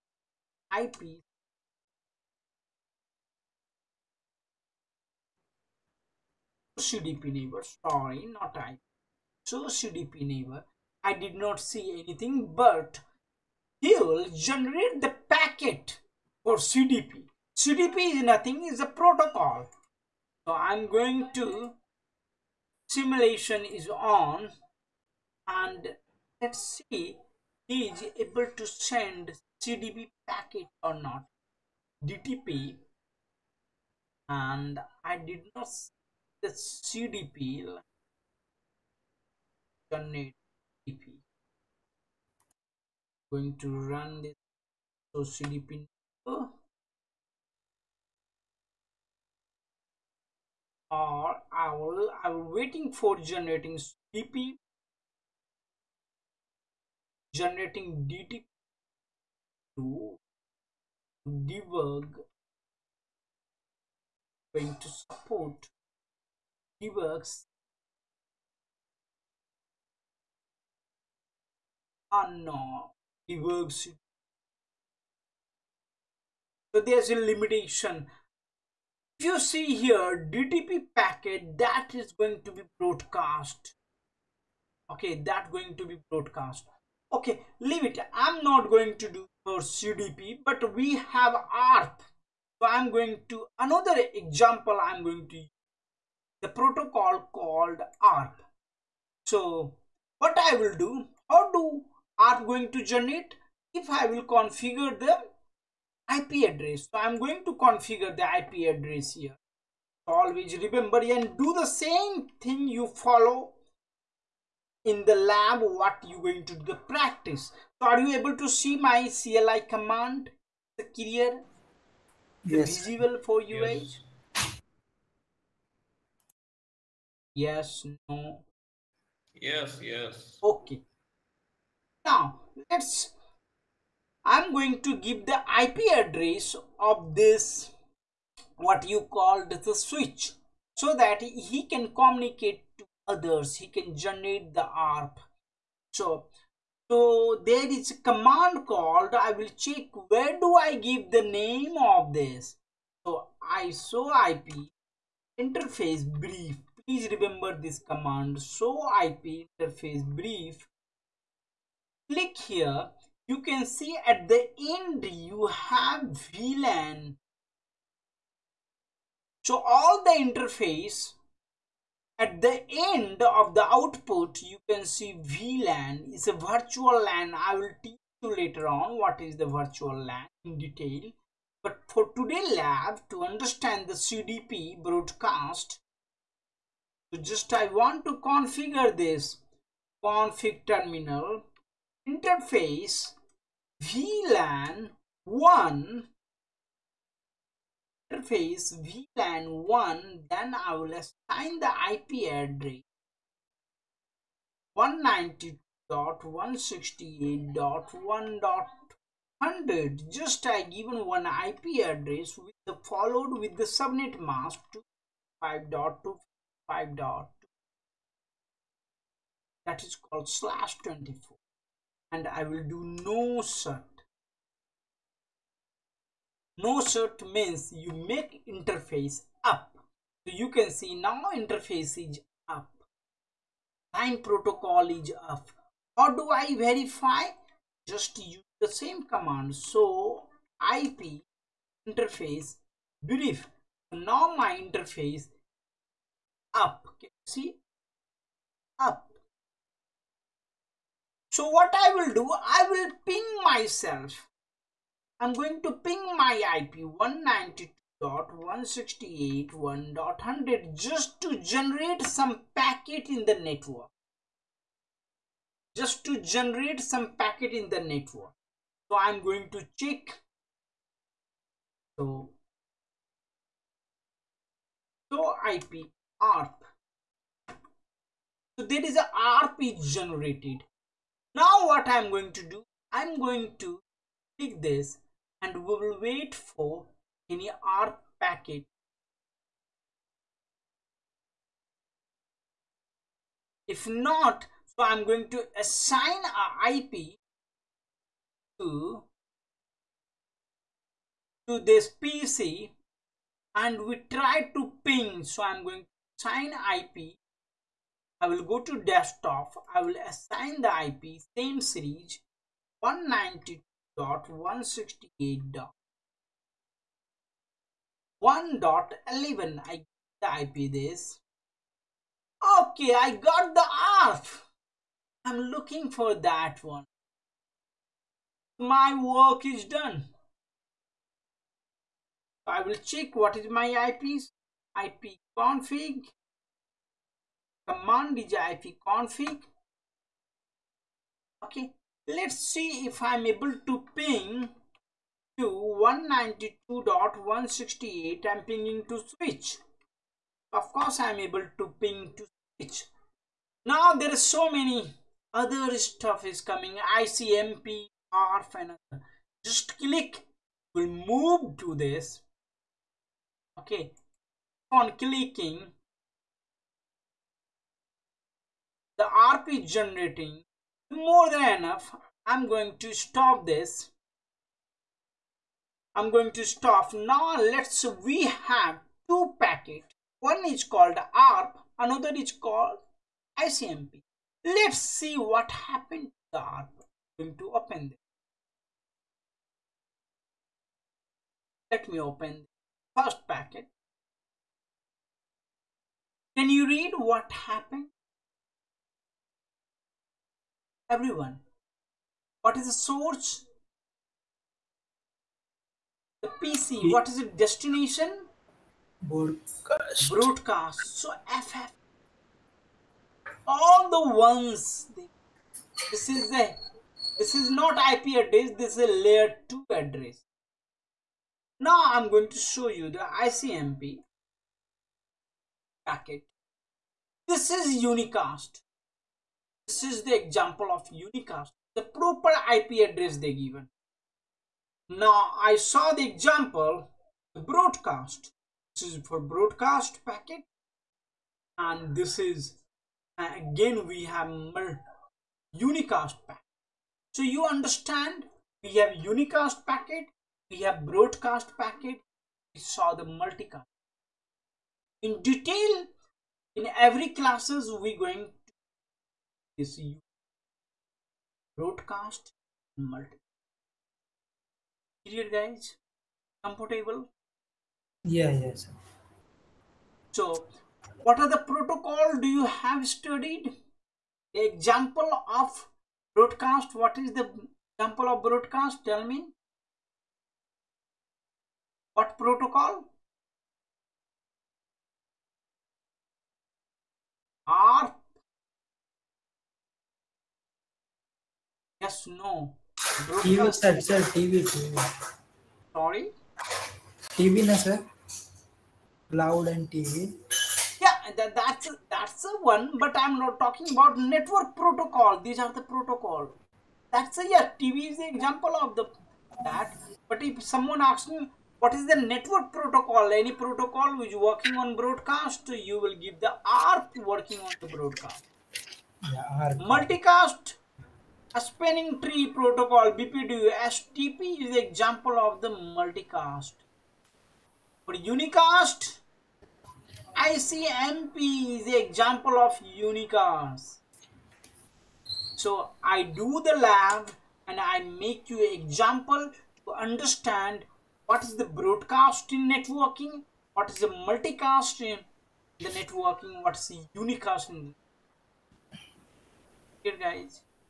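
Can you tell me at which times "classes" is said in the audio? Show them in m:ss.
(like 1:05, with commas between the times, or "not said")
7:37.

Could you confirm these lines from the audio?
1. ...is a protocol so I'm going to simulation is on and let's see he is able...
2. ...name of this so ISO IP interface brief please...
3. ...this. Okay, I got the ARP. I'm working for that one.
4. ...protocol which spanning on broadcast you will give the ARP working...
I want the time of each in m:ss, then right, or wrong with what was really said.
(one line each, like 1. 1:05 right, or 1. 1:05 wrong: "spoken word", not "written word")
1. 0:18 right
2. 2:31 right
3. 5:20 wrong: "looking", not "working"
4. 8:33 wrong: "working", not "spanning".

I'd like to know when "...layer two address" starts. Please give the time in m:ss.
6:59.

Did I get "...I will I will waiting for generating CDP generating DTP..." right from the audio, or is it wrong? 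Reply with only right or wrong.
right.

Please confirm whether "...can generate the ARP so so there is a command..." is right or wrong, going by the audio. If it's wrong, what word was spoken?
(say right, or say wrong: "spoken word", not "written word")
right.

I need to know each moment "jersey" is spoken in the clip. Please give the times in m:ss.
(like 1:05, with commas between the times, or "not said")
not said.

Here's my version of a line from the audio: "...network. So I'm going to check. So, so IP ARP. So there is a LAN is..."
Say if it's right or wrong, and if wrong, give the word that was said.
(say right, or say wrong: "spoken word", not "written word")
wrong: "ARP", not "LAN".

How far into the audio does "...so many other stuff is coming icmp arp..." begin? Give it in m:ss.
5:54.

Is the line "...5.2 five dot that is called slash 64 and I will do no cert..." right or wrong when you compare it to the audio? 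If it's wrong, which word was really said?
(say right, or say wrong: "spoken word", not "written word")
wrong: "24", not "64".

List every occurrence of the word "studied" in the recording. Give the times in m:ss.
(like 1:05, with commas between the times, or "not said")
7:52.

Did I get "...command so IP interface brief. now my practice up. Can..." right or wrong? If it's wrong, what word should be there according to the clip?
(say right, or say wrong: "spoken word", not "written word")
wrong: "interface", not "practice".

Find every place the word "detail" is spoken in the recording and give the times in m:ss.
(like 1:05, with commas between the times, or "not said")
3:00, 7:35.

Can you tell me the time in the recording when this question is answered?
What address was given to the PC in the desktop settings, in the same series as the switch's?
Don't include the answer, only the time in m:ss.
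5:12.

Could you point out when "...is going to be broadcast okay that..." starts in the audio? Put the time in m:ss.
1:21.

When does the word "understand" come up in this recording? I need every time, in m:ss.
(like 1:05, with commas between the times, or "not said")
3:03, 7:27, 8:59.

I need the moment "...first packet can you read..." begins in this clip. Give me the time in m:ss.
6:33.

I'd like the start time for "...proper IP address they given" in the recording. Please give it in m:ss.
7:11.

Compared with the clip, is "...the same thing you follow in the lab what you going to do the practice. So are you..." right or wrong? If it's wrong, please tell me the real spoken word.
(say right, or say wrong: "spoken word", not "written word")
right.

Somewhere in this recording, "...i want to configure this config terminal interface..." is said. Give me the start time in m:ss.
3:07.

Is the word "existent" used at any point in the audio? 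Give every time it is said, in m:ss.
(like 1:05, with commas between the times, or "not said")
not said.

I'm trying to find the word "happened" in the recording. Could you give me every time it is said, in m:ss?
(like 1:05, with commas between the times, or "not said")
6:25, 6:37.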